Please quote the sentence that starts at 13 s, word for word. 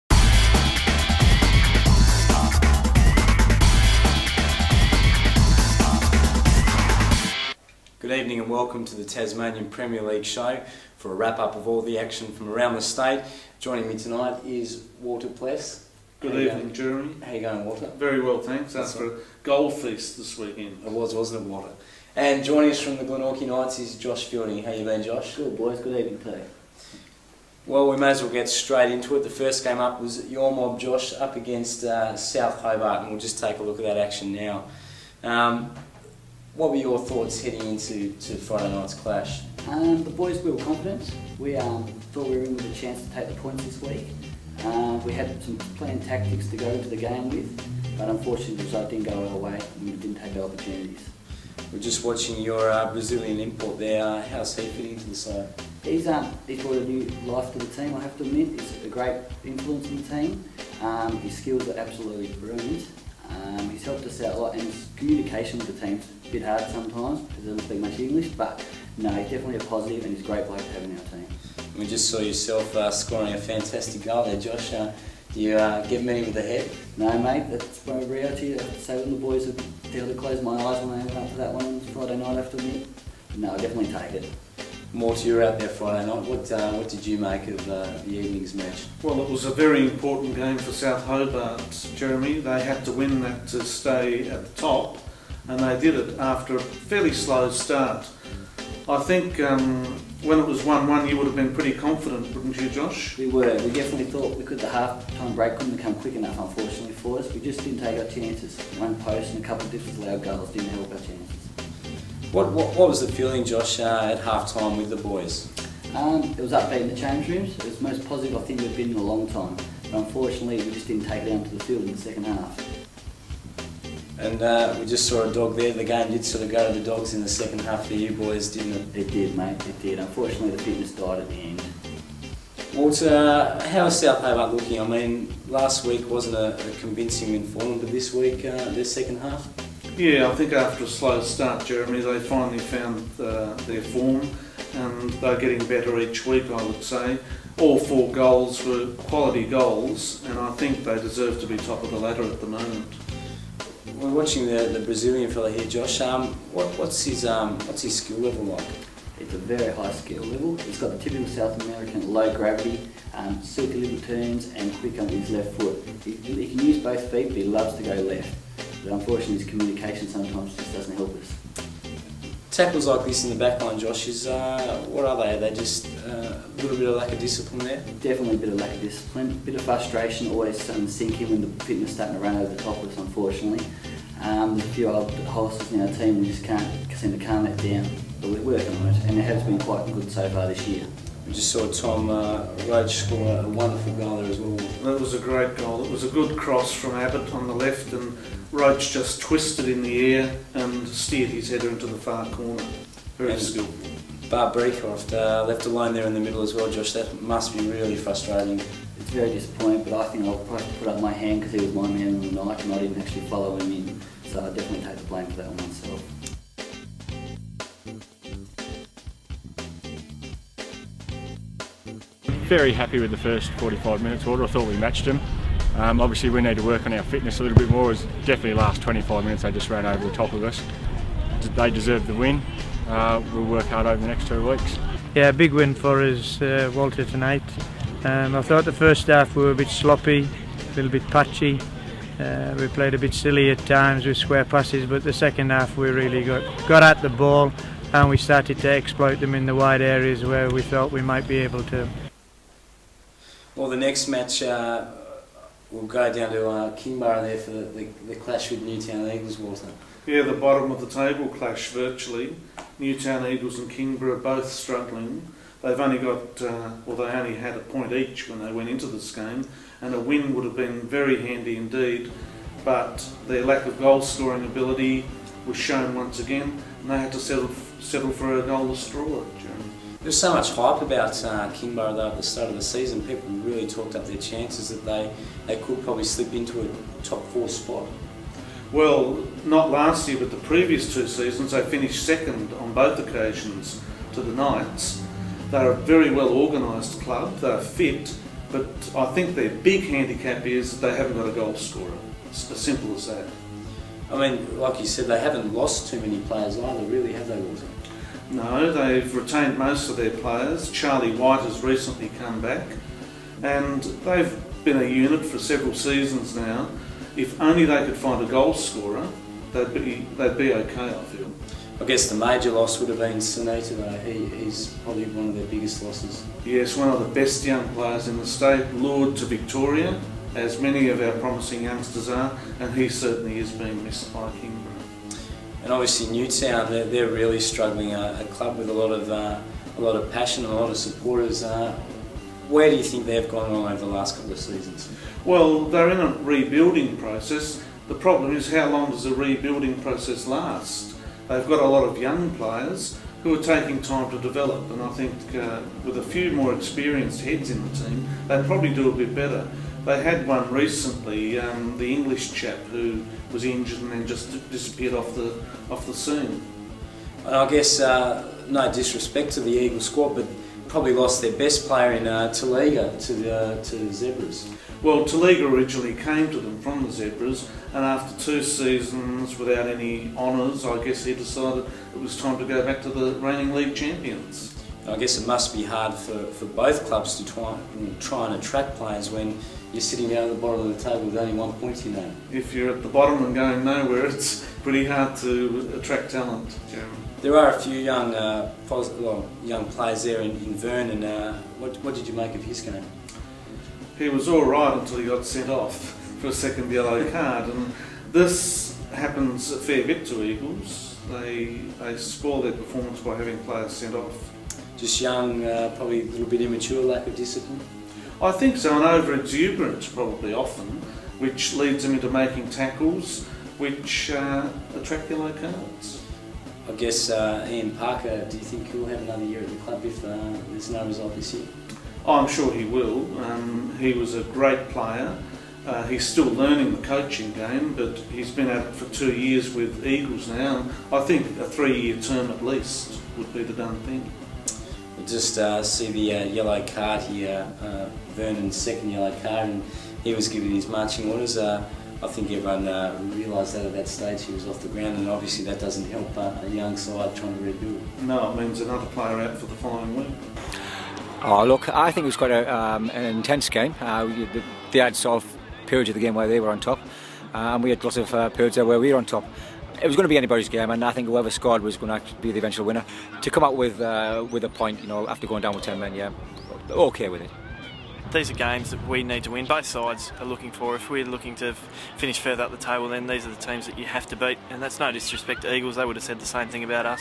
Joining me tonight is Walter Pless.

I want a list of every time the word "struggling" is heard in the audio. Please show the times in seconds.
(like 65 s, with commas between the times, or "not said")
264 s, 337 s.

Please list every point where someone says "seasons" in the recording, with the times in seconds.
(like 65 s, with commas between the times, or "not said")
282 s, 291 s, 315 s, 344 s, 378 s.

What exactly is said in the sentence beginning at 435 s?
Uh, he's still learning the coaching game, but he's been out for two years with Eagles now.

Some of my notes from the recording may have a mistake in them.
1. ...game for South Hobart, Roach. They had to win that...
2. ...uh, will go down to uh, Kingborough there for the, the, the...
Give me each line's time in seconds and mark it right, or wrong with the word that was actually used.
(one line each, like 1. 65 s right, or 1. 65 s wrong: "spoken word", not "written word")
1. 90 s wrong: "Jeremy", not "Roach"
2. 254 s right.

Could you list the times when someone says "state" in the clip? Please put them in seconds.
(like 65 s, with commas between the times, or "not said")
12 s, 328 s.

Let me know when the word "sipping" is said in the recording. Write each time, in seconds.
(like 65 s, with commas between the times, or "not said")
not said.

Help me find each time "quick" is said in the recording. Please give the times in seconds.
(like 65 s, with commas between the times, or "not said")
105 s, 164 s.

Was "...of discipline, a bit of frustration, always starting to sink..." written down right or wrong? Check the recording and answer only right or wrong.
right.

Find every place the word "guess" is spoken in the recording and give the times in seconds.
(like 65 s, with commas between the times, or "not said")
321 s, 367 s, 380 s, 384 s, 426 s.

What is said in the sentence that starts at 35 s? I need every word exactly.
Um, what were your thoughts heading into to Friday night's clash?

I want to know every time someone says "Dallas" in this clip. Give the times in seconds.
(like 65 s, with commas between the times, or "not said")
not said.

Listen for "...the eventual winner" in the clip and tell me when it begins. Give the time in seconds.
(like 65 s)
472 s.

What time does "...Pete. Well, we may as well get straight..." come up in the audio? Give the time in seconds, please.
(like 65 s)
26 s.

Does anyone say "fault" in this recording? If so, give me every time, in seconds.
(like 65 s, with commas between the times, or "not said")
not said.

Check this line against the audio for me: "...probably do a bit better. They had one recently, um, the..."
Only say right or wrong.
right.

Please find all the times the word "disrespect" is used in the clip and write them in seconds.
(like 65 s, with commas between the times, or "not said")
368 s, 484 s.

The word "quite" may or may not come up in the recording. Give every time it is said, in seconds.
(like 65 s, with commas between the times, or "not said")
189 s, 462 s.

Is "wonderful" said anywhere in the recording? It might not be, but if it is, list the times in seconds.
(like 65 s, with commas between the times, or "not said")
193 s.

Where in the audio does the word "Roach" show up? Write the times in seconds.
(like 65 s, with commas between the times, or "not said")
192 s, 198 s.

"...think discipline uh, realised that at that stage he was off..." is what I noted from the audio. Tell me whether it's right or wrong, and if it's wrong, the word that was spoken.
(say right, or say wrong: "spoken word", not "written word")
wrong: "everyone", not "discipline".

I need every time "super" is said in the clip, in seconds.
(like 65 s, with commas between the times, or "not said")
163 s.